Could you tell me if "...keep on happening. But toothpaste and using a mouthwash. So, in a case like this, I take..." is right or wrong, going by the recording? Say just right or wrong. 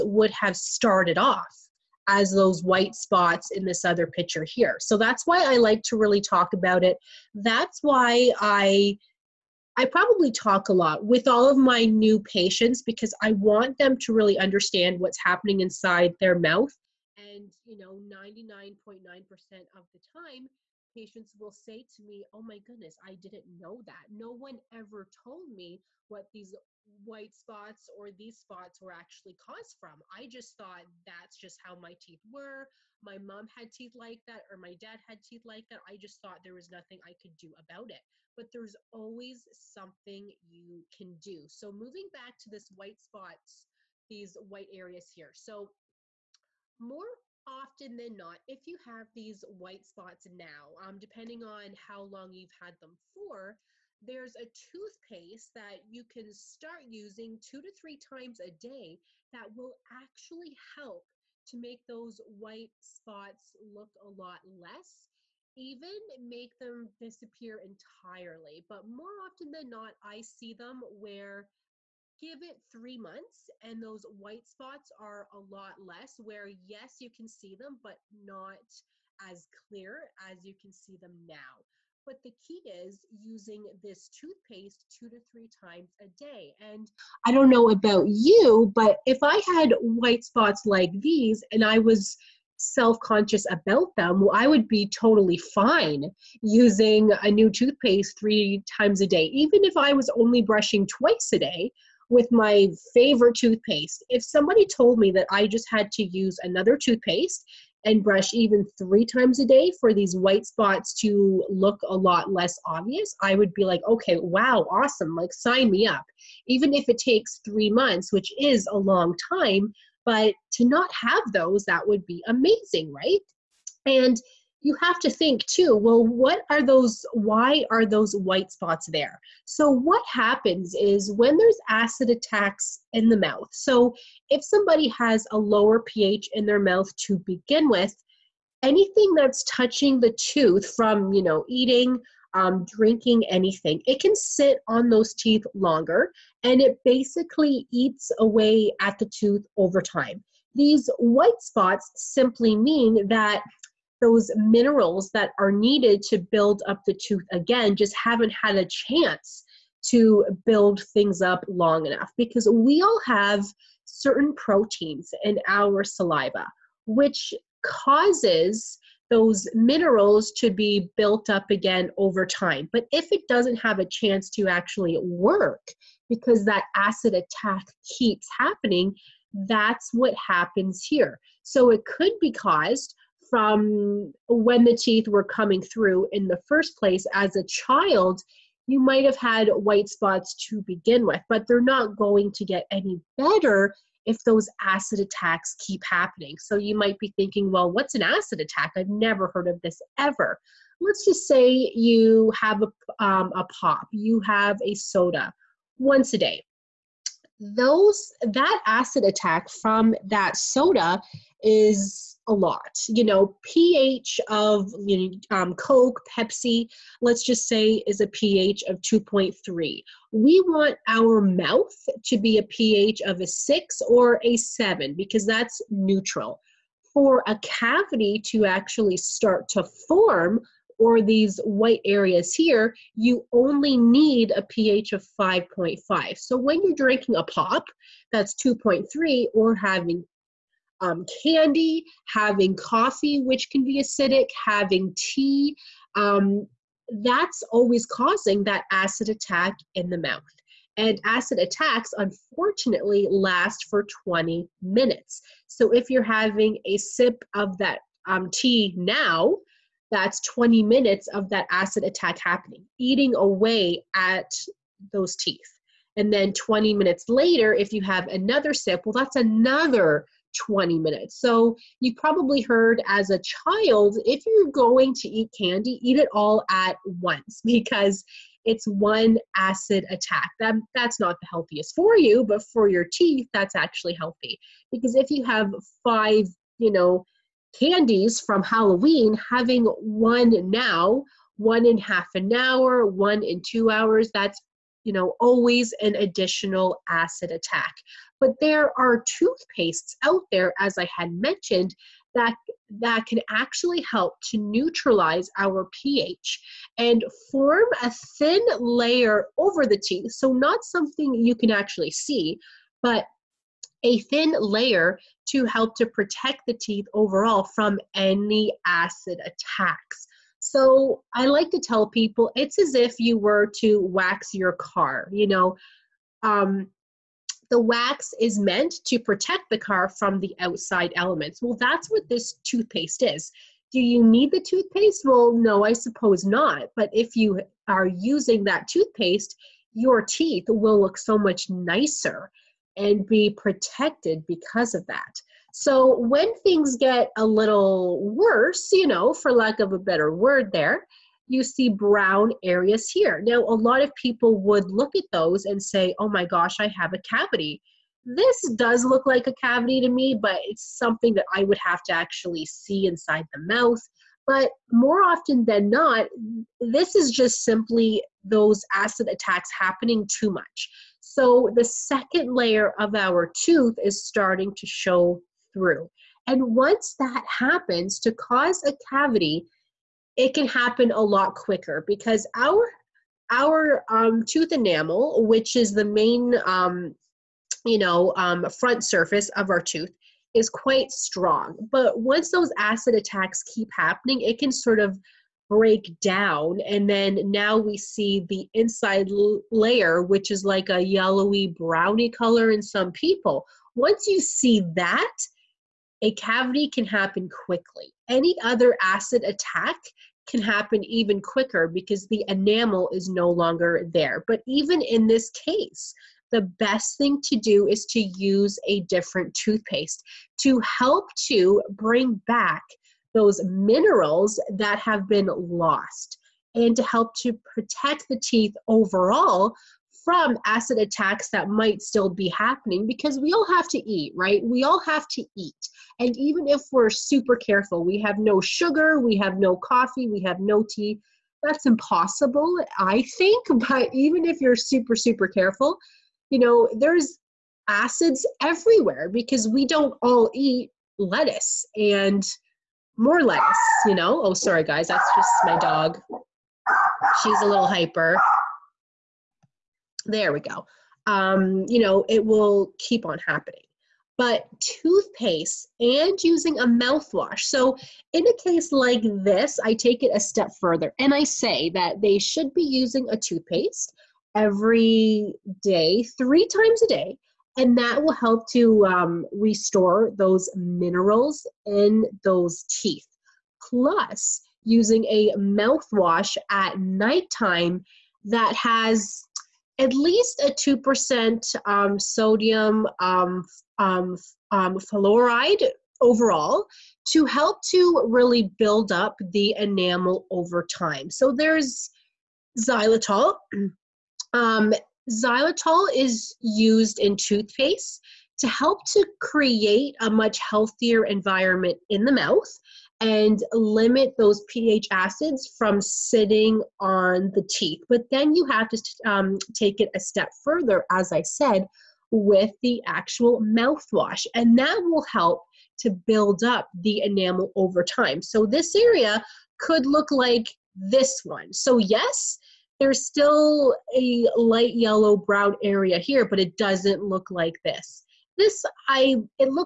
right.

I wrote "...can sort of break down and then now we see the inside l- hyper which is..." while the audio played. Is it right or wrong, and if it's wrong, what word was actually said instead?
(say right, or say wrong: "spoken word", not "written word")
wrong: "layer", not "hyper".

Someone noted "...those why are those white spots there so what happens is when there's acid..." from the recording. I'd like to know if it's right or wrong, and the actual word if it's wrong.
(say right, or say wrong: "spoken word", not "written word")
right.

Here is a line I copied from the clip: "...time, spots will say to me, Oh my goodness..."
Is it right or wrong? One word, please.
wrong.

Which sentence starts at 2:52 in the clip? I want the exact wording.
But if it doesn't have a chance to actually work because that acid attack keeps happening, that's what happens here.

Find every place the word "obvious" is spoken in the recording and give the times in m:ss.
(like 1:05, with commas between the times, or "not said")
1:52.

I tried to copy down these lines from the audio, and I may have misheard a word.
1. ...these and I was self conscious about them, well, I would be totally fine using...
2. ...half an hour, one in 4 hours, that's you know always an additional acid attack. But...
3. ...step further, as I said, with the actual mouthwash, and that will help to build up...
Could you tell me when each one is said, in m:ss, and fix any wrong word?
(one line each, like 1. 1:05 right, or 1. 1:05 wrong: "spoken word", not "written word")
1. 1:31 right
2. 4:51 wrong: "2", not "4"
3. 8:39 right.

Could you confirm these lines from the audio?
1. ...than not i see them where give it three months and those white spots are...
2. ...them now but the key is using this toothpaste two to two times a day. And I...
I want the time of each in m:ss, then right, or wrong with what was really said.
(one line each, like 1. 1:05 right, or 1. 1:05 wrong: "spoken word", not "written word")
1. 1:09 right
2. 1:20 wrong: "three", not "two".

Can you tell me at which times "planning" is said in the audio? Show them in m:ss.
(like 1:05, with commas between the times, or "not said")
not said.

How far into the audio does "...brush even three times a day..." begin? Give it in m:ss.
1:48.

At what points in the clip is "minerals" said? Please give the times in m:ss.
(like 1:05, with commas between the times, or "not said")
2:34, 2:49, 7:03, 8:00.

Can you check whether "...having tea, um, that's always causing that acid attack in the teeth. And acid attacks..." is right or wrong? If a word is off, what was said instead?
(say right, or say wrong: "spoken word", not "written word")
wrong: "mouth", not "teeth".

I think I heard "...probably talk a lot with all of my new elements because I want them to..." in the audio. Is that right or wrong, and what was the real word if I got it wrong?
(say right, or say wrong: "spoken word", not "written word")
wrong: "patients", not "elements".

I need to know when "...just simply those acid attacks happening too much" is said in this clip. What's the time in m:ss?
6:07.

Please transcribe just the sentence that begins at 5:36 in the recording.
But if you are using that toothpaste, your teeth will look so much nicer and be protected because of that.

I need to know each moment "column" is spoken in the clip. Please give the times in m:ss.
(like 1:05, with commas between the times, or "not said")
not said.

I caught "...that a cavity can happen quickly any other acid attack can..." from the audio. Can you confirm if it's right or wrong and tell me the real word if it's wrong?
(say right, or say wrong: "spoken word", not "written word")
right.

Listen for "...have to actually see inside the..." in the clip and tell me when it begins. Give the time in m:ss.
6:01.